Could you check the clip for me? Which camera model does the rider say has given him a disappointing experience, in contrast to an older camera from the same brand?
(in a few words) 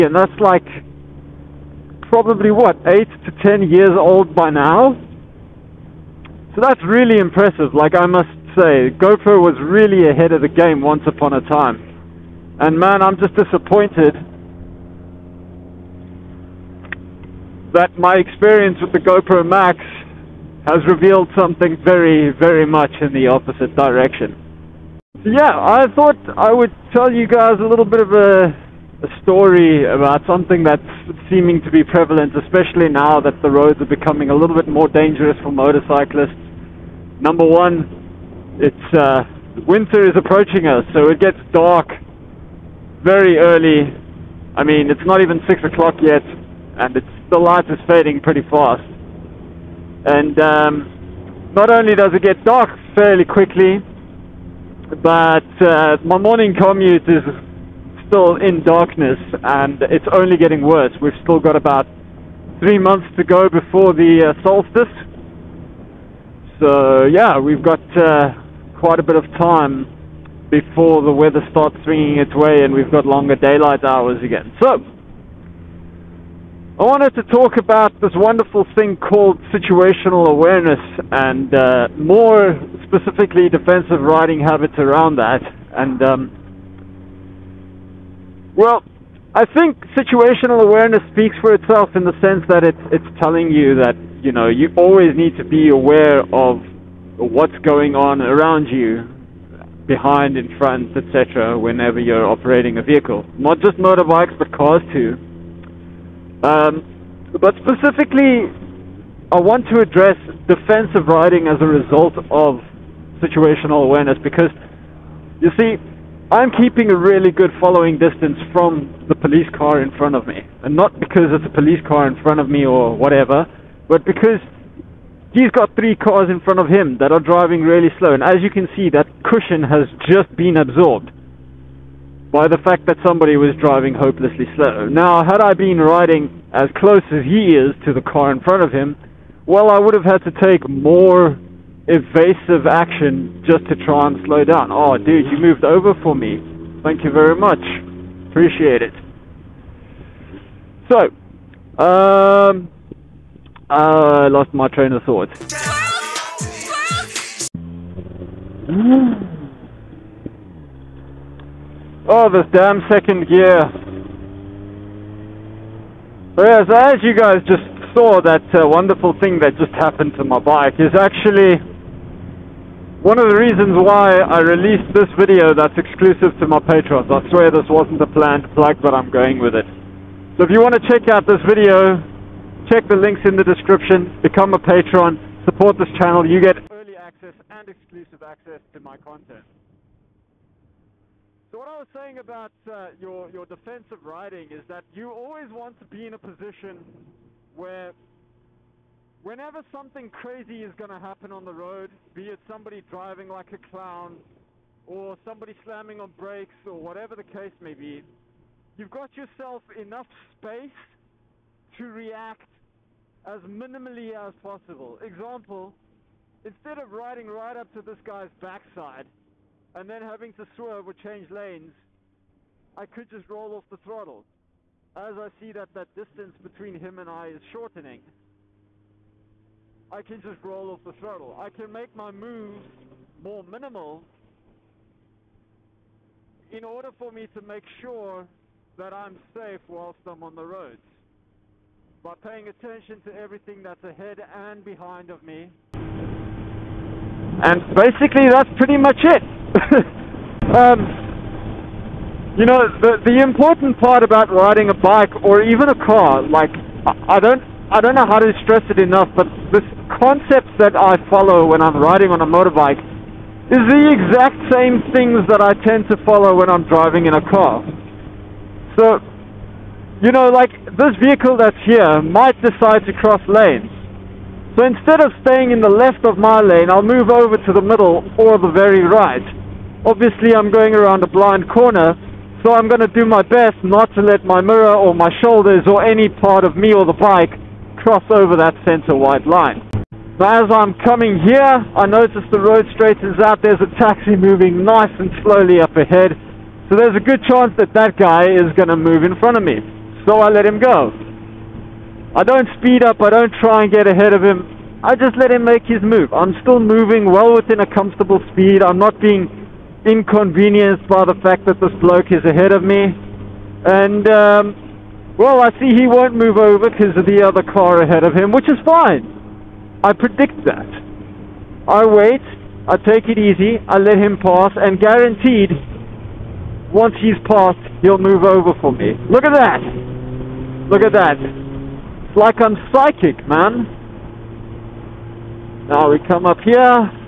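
GoPro Max.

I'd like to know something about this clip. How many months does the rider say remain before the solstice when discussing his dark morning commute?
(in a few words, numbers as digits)
3.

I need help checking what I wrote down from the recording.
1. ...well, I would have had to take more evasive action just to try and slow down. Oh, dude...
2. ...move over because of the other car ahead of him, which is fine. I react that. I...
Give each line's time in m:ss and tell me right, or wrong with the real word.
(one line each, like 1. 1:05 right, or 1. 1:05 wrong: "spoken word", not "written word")
1. 2:19 right
2. 5:16 wrong: "predict", not "react".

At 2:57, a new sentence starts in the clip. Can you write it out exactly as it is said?
I swear this wasn't a planned plug, but I'm going with it.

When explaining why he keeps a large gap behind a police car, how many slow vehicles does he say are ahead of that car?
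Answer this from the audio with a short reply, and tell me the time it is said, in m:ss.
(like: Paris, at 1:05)
3, at 2:05.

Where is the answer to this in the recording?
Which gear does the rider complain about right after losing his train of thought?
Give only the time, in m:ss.
2:42.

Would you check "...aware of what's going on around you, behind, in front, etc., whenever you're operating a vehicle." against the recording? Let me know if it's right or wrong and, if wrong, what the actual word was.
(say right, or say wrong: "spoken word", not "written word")
right.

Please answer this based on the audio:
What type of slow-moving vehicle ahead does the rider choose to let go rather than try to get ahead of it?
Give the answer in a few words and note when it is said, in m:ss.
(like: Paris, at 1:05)
taxi, at 4:53.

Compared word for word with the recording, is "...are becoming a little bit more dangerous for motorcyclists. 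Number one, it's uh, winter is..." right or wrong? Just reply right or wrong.
right.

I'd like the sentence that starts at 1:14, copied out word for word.
So, I wanted to talk about this wonderful thing called situational awareness and uh, more specifically defensive riding habits around that.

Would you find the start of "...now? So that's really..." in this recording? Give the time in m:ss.
0:04.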